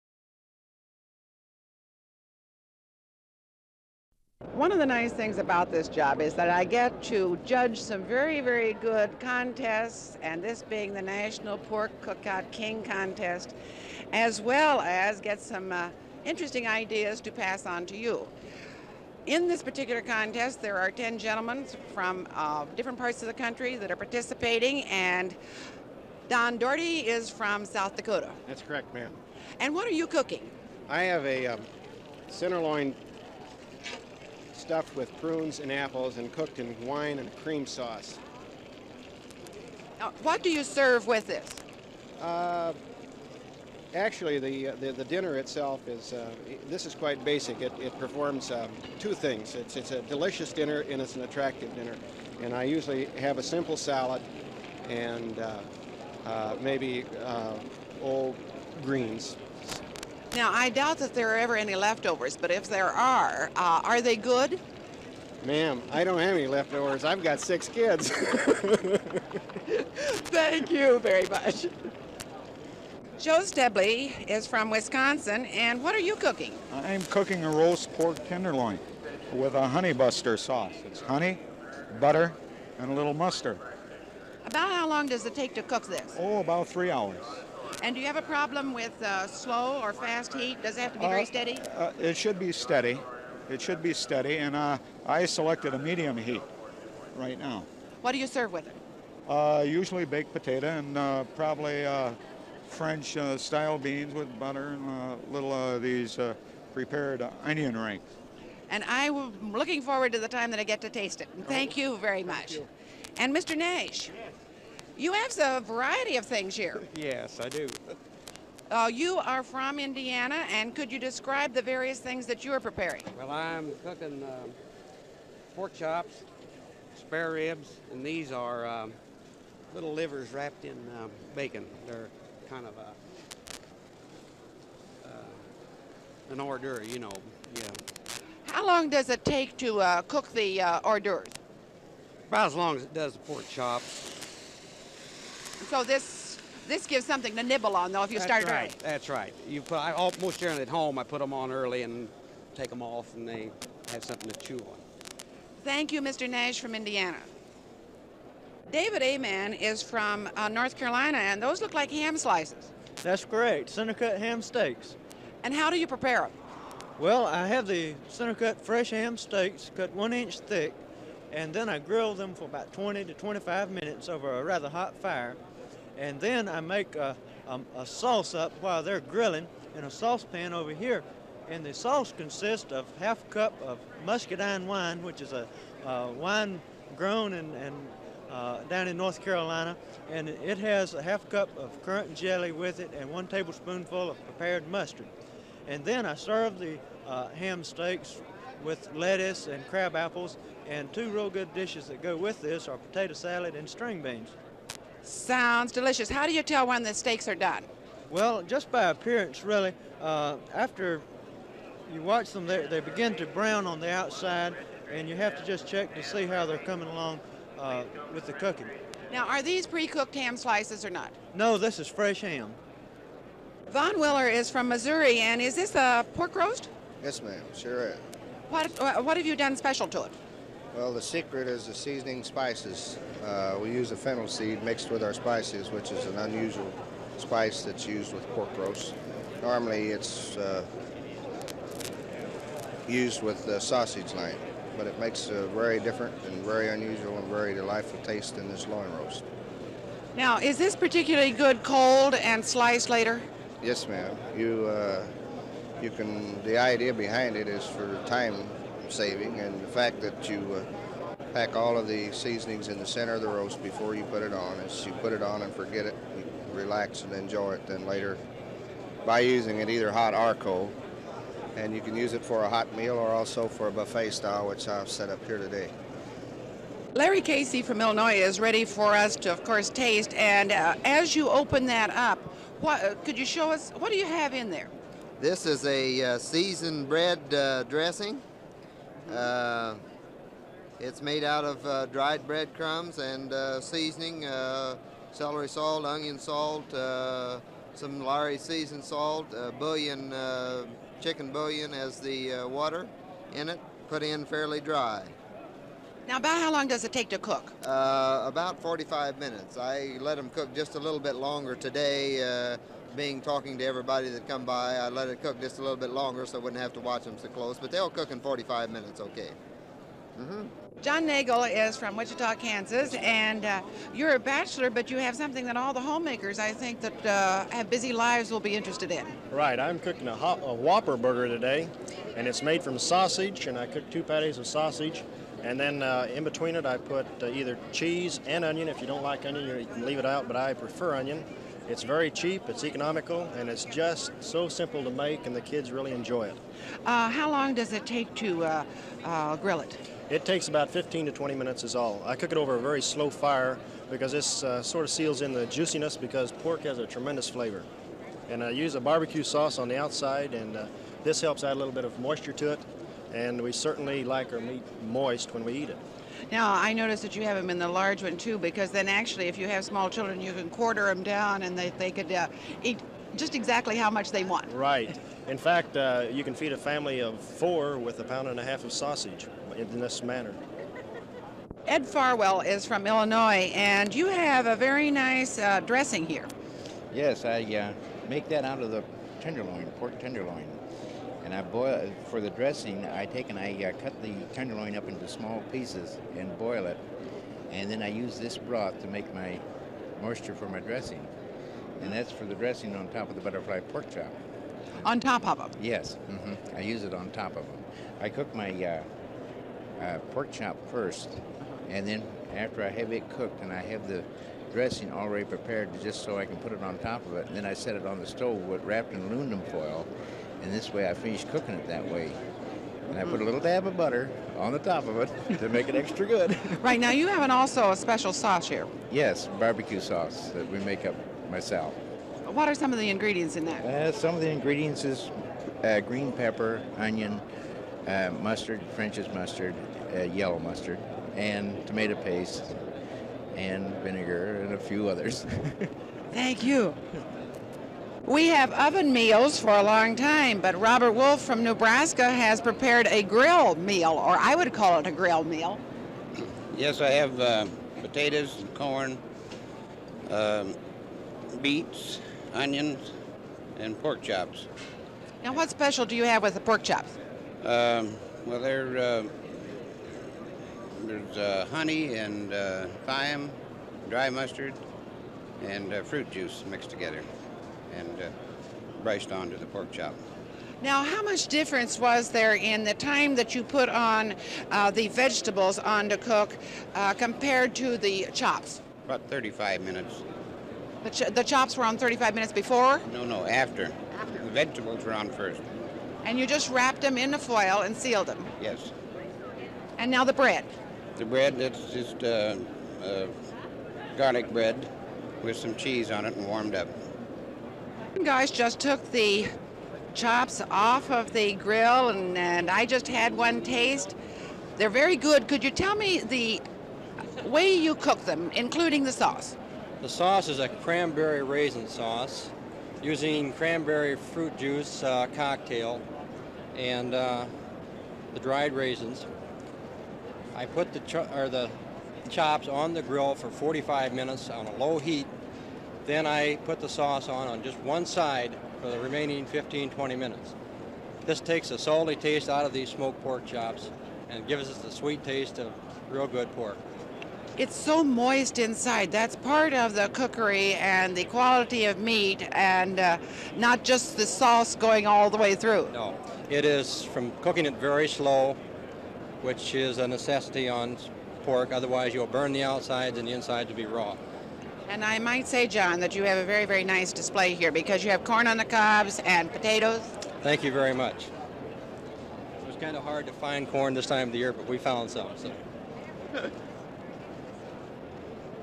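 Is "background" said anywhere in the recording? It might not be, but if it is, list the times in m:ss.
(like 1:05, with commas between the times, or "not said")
not said.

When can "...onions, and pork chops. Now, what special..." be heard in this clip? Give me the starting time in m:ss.
7:42.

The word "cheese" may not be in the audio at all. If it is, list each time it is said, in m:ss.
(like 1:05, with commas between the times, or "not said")
5:37, 8:25.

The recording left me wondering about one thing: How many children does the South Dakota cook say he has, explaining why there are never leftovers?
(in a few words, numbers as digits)
6.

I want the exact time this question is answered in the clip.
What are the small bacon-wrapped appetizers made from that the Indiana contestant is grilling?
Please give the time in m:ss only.
2:09.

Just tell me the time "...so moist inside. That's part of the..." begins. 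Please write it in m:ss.
9:07.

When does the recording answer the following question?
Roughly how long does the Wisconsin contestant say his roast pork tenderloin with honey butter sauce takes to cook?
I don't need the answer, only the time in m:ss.
1:26.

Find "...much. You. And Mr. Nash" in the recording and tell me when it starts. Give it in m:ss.
1:52.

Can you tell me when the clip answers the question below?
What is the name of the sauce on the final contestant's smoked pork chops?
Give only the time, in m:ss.
8:40.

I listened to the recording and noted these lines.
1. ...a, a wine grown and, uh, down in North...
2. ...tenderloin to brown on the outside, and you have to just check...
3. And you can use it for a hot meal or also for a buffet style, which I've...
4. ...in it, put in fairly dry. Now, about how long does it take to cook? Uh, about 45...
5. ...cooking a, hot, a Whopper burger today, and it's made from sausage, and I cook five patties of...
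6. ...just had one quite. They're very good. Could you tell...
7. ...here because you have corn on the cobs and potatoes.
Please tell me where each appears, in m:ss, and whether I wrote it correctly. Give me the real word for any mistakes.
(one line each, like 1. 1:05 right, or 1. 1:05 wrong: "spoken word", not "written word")
1. 3:05 right
2. 3:32 wrong: "begin", not "tenderloin"
3. 4:31 right
4. 5:03 right
5. 5:29 wrong: "two", not "five"
6. 8:32 wrong: "taste", not "quite"
7. 9:27 right.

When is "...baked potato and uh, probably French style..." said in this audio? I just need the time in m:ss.
1:40.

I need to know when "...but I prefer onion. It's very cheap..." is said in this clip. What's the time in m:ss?
5:40.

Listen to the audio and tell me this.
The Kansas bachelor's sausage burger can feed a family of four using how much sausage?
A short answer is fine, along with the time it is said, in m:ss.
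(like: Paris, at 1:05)
1.5 pounds, at 6:17.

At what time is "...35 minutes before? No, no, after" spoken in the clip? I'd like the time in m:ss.
8:11.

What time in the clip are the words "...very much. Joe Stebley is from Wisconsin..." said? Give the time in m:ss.
1:10.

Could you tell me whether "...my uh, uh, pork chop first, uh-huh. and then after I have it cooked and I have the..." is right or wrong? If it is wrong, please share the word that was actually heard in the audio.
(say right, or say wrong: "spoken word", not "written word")
right.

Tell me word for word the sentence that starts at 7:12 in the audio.
What are some of the ingredients in that?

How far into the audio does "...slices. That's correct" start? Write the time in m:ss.
2:42.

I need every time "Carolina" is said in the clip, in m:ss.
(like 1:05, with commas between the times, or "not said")
2:40, 3:09.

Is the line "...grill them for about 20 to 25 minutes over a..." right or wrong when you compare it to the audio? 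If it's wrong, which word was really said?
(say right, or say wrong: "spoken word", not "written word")
right.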